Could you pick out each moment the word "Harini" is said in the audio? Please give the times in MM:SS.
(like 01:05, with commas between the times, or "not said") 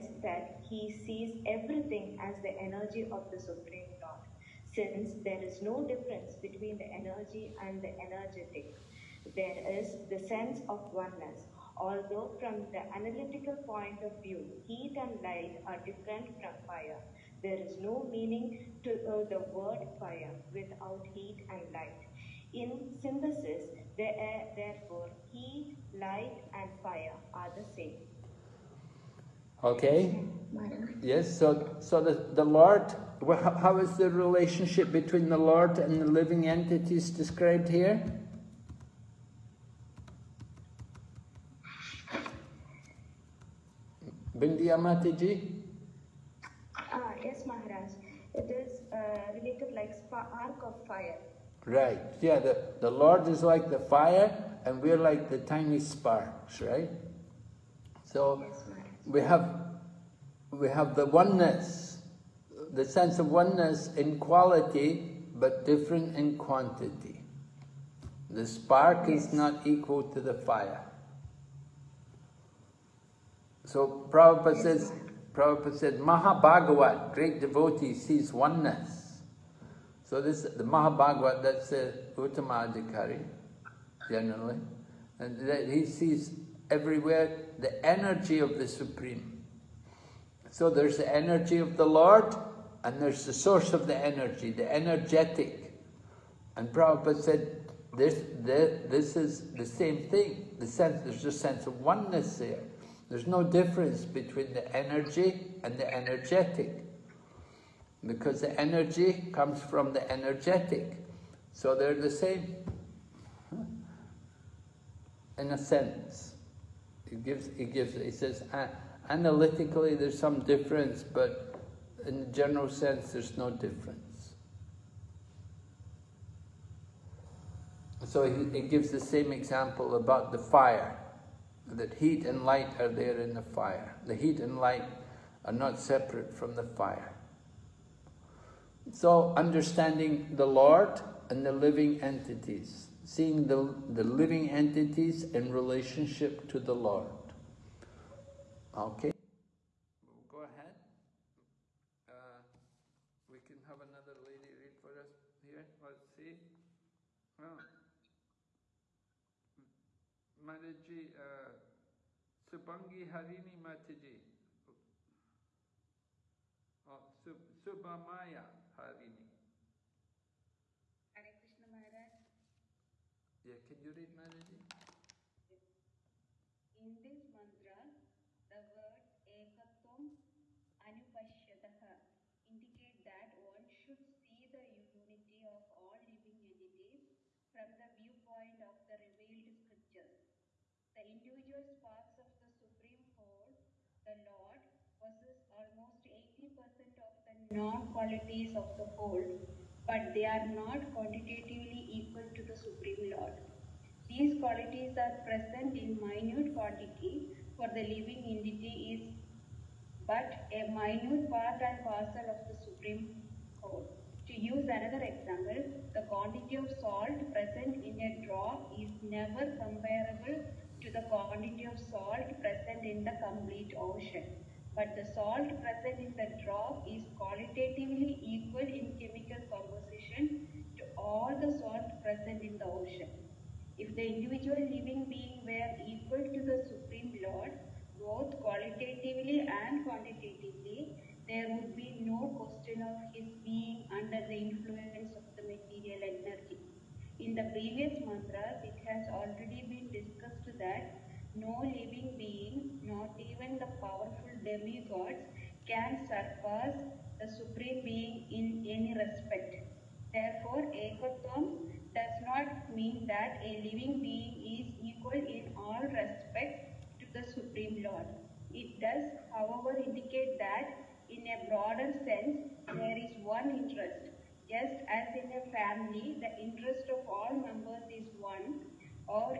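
02:43, 02:47.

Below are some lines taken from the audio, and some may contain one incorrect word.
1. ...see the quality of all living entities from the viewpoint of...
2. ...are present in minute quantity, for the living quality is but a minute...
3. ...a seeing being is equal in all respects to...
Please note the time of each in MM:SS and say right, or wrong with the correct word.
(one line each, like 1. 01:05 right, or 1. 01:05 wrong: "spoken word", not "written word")
1. 03:04 wrong: "unity", not "quality"
2. 03:25 wrong: "entity", not "quality"
3. 04:23 wrong: "living", not "seeing".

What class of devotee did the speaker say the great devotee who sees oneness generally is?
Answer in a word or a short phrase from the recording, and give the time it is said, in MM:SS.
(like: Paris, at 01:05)
Uttamadhikari, at 01:22.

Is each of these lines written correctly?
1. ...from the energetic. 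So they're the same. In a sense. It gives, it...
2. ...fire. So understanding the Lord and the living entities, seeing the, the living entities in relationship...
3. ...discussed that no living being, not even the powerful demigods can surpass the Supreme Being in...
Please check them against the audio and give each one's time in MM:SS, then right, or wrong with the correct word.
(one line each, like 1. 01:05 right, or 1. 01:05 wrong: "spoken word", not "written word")
1. 01:49 right
2. 02:16 right
3. 04:09 right.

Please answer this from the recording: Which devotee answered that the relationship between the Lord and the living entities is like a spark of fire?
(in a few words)
Bindiya Mataji.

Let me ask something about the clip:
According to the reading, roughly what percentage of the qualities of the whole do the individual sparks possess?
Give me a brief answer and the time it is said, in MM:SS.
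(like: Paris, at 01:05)
80%, at 03:16.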